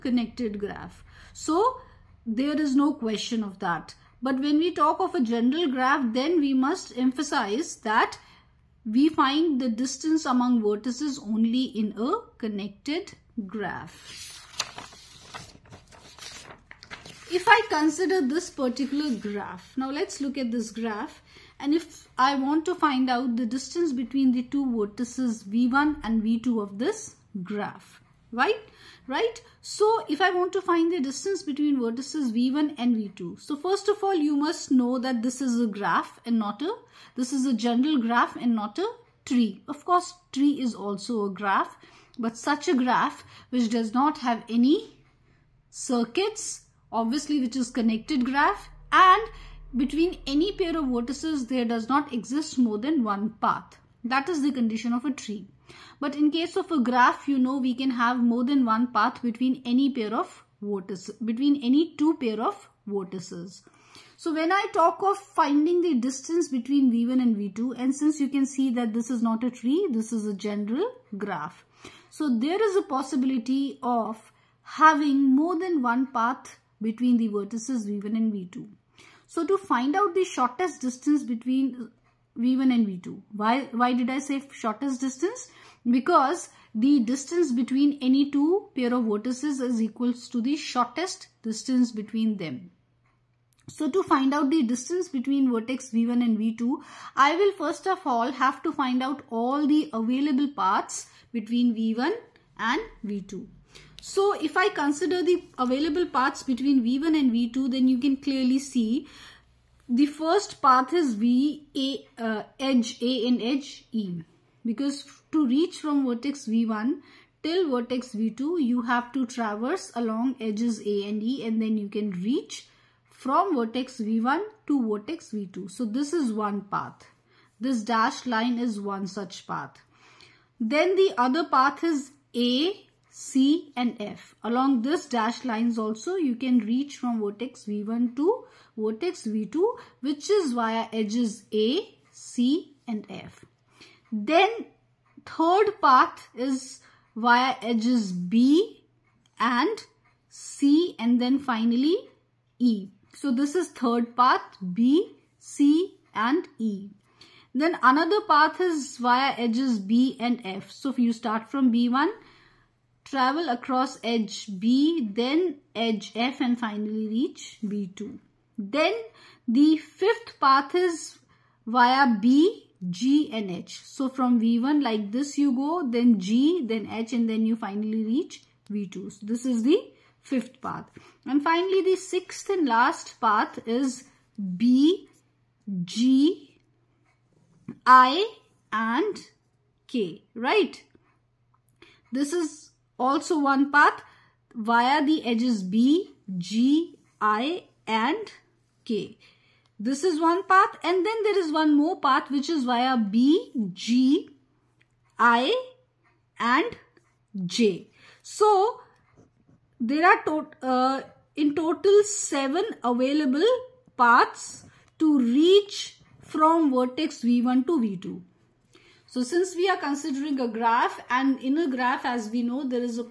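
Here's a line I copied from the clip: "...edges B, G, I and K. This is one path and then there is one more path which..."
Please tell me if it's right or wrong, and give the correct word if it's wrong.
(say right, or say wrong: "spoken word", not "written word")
right.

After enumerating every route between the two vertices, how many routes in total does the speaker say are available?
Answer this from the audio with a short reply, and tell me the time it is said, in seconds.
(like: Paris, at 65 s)
7, at 212 s.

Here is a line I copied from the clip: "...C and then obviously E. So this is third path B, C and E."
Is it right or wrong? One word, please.
wrong.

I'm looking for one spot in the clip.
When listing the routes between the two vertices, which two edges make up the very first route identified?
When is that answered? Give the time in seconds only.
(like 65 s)
112 s.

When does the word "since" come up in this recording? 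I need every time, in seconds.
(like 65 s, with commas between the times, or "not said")
67 s, 219 s.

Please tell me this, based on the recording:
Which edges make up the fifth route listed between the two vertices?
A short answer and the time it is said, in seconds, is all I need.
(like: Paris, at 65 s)
B, G and H, at 172 s.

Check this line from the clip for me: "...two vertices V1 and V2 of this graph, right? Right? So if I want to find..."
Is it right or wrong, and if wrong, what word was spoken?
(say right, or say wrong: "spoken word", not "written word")
right.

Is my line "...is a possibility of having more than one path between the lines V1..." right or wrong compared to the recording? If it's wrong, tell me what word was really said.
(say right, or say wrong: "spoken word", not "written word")
wrong: "vertices", not "lines".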